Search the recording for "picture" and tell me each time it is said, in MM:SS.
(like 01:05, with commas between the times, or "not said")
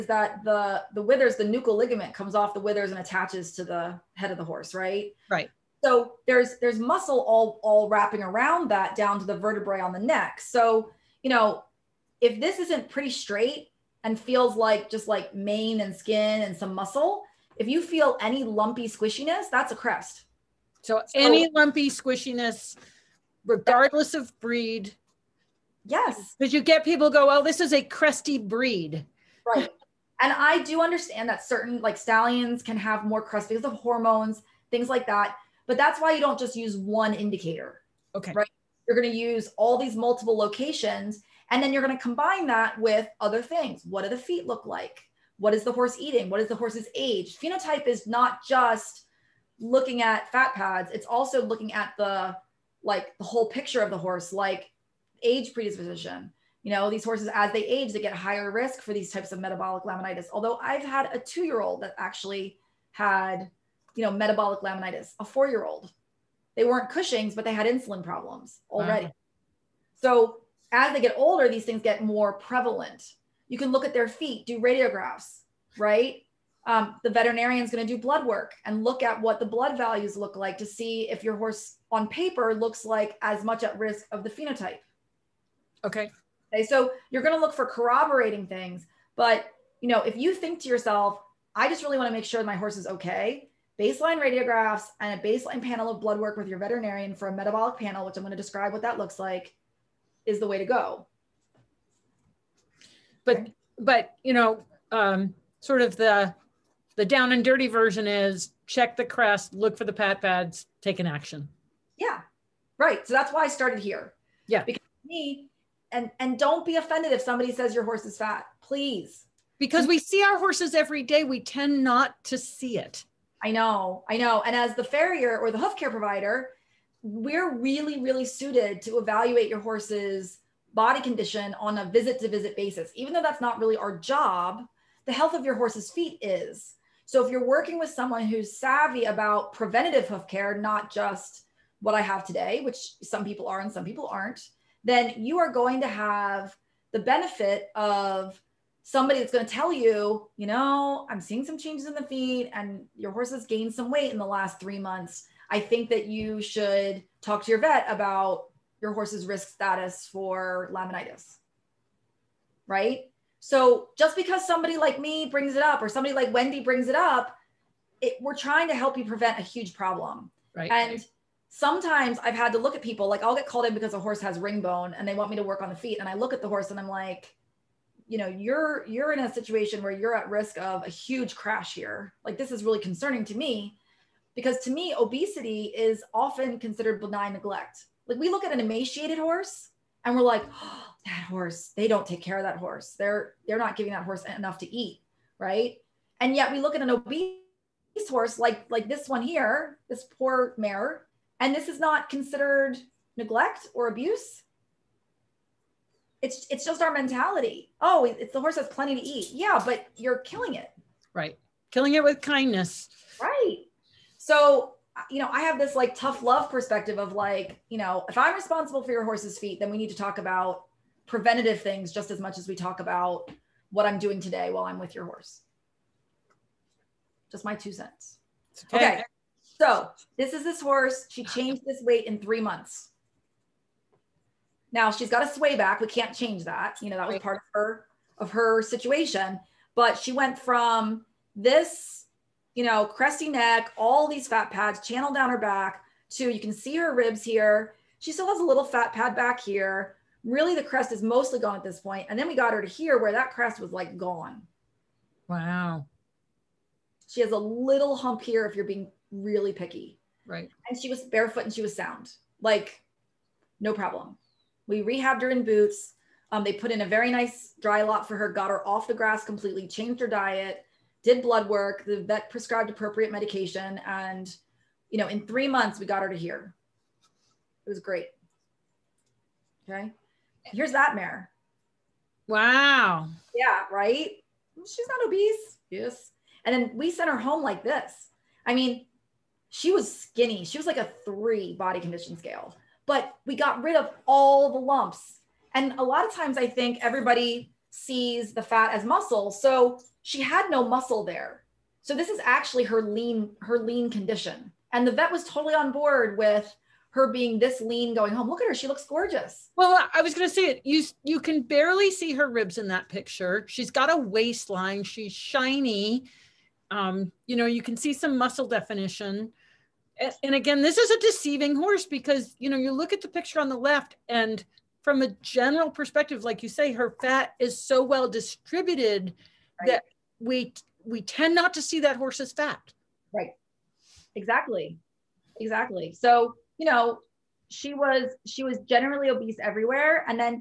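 00:53, 05:12, 05:23.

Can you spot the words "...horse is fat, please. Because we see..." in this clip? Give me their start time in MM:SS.
01:57.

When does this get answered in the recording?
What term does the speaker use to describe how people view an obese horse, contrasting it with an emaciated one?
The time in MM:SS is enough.
03:07.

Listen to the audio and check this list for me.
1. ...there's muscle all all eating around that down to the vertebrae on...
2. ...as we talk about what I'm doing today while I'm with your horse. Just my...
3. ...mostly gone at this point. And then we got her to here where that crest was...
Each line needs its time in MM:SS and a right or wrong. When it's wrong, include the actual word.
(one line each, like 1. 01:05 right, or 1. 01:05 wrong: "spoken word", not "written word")
1. 00:06 wrong: "wrapping", not "eating"
2. 03:42 right
3. 04:11 right.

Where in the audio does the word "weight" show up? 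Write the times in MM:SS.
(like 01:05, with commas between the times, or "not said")
02:33, 03:51.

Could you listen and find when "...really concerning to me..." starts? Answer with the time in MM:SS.
03:02.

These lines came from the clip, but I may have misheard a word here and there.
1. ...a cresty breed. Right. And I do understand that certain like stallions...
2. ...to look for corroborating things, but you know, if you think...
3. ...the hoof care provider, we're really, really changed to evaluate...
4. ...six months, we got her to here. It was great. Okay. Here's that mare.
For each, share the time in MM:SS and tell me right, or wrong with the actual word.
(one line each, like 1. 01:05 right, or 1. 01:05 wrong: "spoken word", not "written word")
1. 00:27 right
2. 01:27 right
3. 02:05 wrong: "suited", not "changed"
4. 04:35 wrong: "three", not "six".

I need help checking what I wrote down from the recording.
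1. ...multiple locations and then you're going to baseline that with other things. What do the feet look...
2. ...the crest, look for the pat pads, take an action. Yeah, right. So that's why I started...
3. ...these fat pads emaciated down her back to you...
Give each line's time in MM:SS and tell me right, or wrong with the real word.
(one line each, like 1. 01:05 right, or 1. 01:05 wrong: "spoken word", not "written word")
1. 00:39 wrong: "combine", not "baseline"
2. 01:48 right
3. 04:04 wrong: "channeled", not "emaciated".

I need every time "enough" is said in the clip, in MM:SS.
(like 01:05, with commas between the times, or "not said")
03:14.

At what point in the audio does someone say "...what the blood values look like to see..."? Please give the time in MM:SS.
01:19.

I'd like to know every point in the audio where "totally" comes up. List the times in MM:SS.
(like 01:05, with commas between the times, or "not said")
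05:05.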